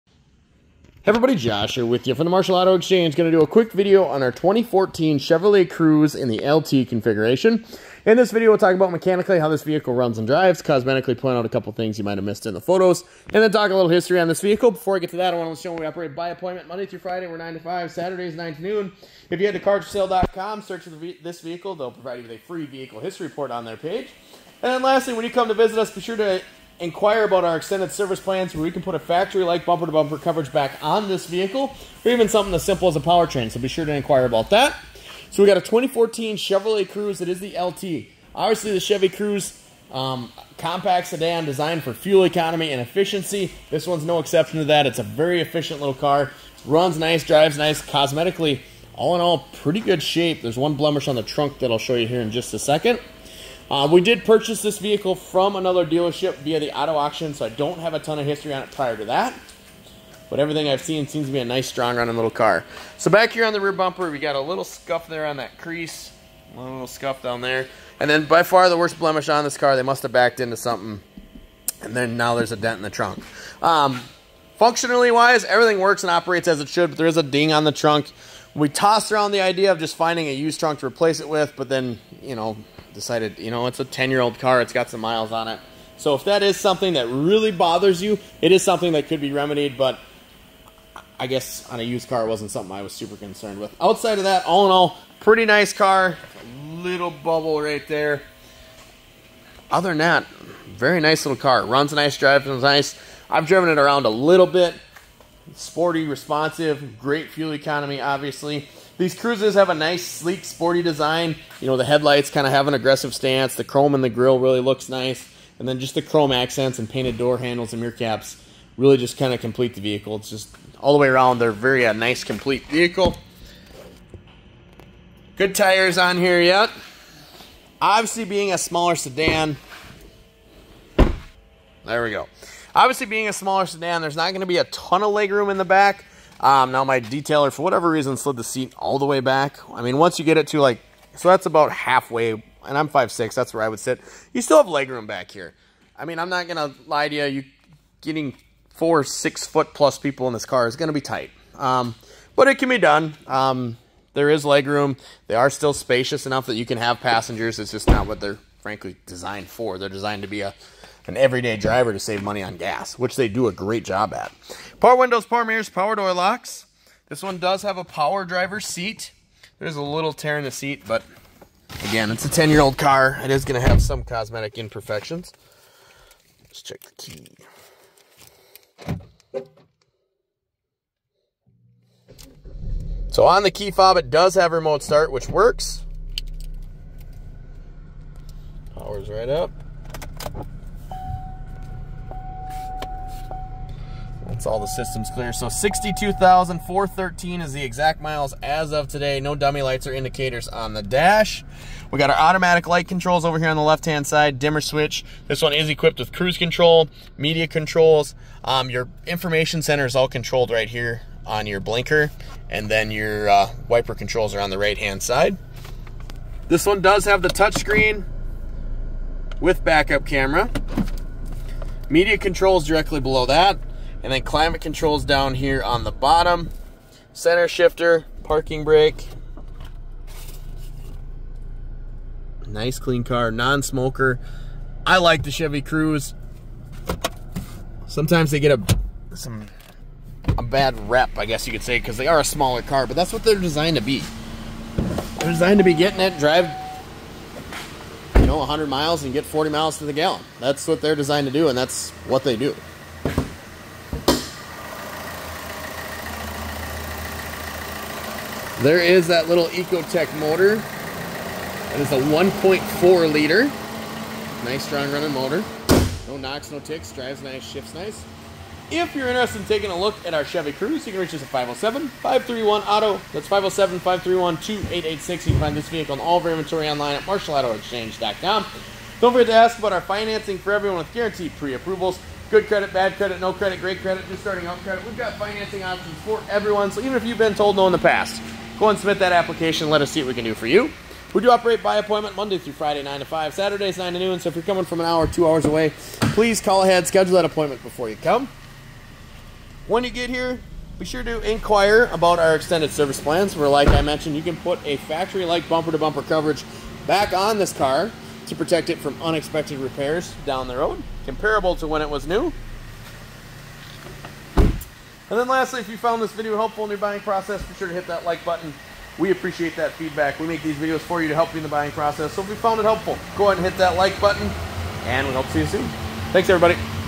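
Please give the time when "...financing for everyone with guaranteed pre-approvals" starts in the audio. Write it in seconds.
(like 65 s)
279 s.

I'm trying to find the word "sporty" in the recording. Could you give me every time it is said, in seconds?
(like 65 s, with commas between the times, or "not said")
105 s, 110 s.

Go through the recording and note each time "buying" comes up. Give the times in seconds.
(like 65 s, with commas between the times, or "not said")
316 s, 321 s.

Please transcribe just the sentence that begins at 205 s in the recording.
This one is equipped with cruise control, media controls.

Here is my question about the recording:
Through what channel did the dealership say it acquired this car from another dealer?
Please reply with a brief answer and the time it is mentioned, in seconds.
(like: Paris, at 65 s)
auto auction, at 56 s.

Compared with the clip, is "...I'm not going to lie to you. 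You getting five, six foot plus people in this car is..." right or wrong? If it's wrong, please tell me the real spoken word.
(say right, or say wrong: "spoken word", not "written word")
wrong: "four", not "five".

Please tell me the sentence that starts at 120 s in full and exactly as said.
It's just all the way around, they're very a uh, nice, complete vehicle.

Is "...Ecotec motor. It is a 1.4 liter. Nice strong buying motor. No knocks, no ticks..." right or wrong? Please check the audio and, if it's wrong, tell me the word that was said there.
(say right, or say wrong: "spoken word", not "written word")
wrong: "running", not "buying".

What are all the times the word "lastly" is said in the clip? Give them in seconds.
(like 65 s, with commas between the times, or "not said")
24 s, 315 s.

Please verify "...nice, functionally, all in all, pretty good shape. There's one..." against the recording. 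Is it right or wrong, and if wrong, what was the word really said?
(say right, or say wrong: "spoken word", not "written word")
wrong: "cosmetically", not "functionally".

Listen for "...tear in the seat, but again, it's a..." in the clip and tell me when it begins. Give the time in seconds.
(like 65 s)
170 s.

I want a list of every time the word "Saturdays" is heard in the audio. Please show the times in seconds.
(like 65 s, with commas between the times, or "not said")
17 s, 293 s.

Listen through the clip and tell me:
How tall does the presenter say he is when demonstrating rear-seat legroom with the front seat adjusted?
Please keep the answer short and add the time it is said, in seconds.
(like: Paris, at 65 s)
5'6", at 142 s.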